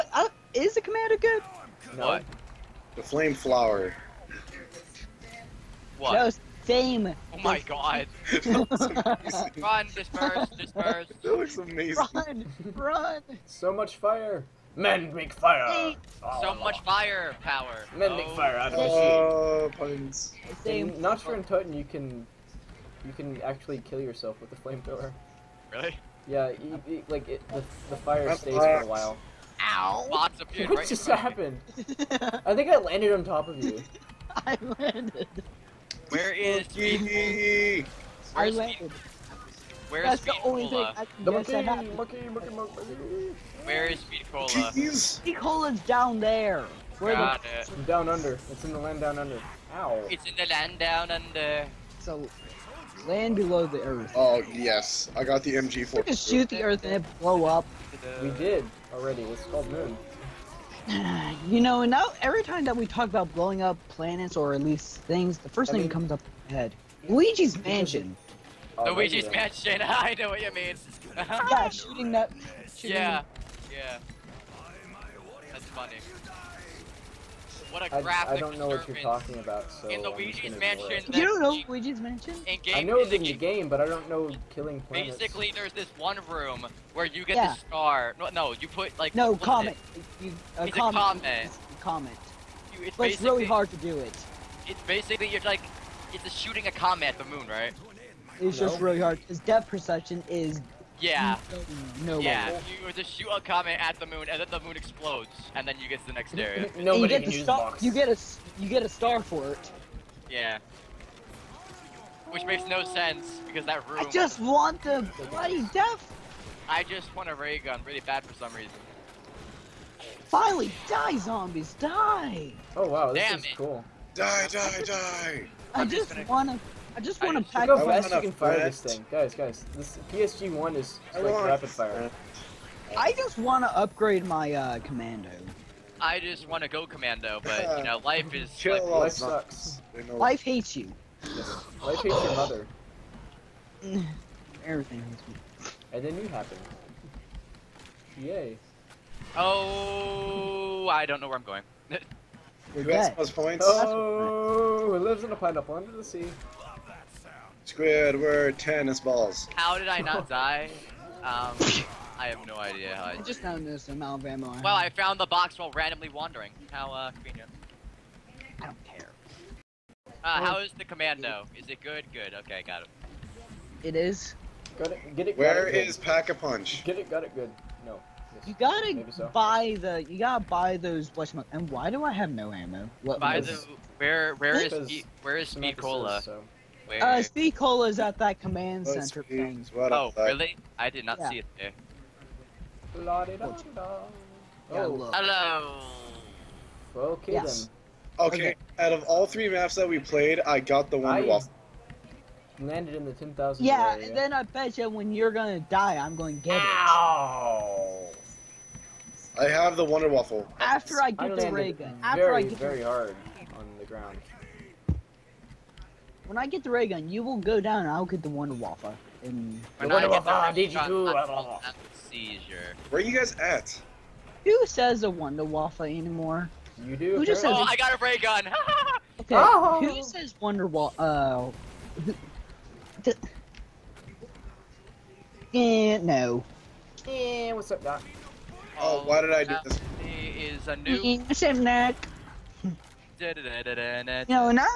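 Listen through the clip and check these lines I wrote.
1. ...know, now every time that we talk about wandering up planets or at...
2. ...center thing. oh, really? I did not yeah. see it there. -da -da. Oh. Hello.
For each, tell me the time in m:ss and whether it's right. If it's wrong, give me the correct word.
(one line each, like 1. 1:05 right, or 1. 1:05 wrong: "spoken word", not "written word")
1. 1:01 wrong: "blowing", not "wandering"
2. 3:09 right.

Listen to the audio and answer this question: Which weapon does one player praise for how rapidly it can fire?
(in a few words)
PSG1.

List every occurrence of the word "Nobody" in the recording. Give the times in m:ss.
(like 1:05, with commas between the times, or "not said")
1:46.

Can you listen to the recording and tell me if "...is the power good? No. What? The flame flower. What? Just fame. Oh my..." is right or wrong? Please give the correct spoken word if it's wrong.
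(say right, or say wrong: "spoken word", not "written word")
wrong: "commander", not "power".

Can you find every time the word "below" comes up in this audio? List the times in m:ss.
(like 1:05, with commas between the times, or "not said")
0:53.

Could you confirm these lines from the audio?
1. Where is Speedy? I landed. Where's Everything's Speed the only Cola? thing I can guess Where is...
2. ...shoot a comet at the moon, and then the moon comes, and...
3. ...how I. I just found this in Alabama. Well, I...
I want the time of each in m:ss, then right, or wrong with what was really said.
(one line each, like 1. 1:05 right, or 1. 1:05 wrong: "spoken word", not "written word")
1. 0:36 wrong: "That", not "Everything"
2. 1:43 wrong: "explodes", not "comes"
3. 2:42 right.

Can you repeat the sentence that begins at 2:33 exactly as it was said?
Oh, it lives in a pineapple under the sea.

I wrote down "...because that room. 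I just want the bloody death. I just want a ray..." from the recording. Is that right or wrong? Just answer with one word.
right.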